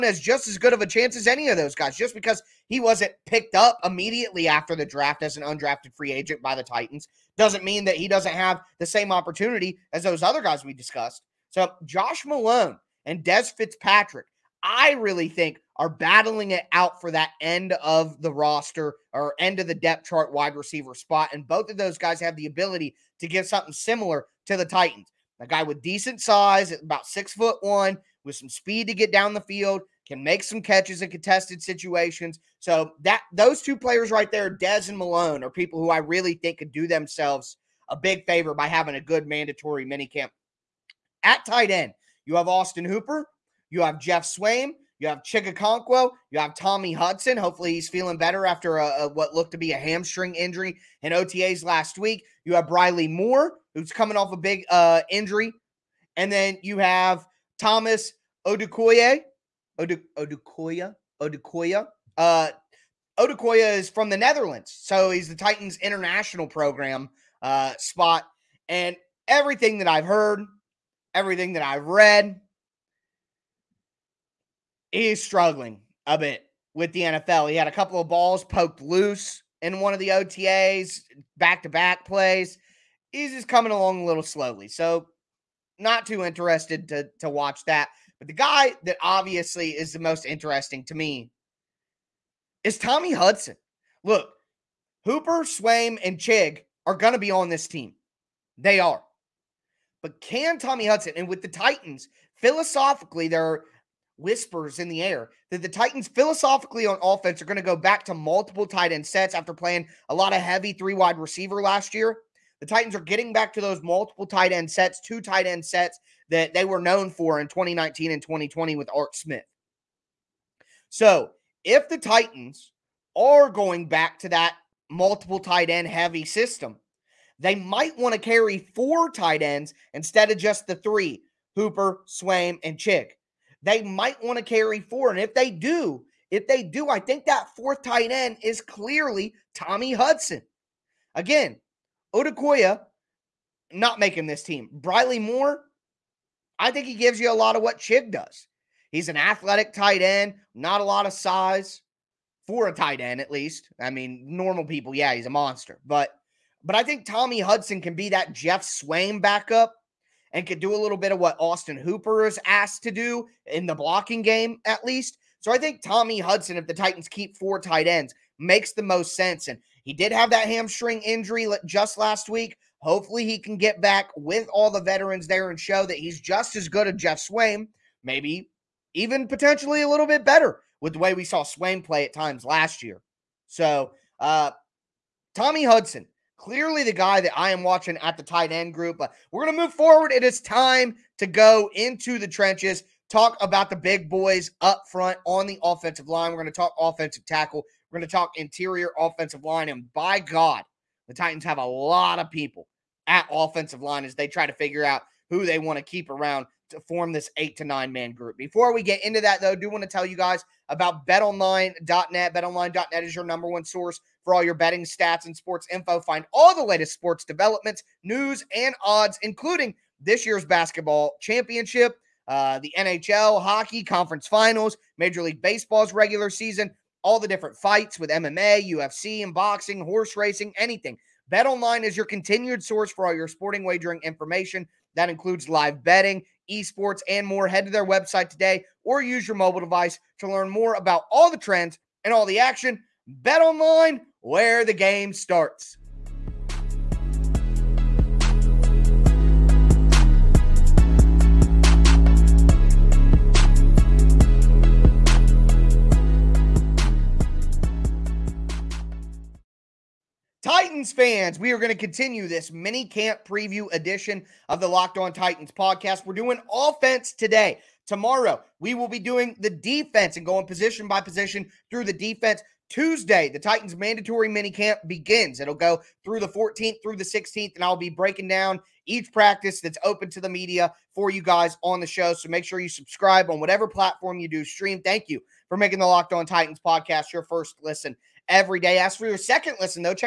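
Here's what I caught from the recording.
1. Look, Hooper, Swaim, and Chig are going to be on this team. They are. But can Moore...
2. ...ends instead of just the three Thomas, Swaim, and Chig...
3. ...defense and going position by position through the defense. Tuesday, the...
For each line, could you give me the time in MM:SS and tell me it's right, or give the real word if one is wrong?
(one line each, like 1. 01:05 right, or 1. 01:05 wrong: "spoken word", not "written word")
1. 01:34 wrong: "Tommy", not "Moore"
2. 02:09 wrong: "Hooper", not "Thomas"
3. 04:29 right.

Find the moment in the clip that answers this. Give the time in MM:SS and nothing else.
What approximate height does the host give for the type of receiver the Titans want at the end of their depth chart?
00:27.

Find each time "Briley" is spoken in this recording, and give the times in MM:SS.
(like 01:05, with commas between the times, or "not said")
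00:52, 02:24.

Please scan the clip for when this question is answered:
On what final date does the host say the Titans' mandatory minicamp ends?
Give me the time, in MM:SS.
04:37.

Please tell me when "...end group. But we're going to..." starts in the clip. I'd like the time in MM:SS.
03:08.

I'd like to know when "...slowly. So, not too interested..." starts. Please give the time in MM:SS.
01:24.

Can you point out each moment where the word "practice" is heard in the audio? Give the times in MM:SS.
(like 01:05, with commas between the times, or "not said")
04:39.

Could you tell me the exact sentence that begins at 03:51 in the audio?
BetOnline is your continued source for all your sporting wagering information.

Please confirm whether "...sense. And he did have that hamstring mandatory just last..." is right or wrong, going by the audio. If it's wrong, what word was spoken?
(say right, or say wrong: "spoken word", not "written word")
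wrong: "injury", not "mandatory".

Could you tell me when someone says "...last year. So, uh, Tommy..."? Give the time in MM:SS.
03:02.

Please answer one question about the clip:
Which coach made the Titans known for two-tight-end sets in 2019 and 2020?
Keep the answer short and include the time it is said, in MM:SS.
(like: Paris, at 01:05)
Art Smith, at 01:58.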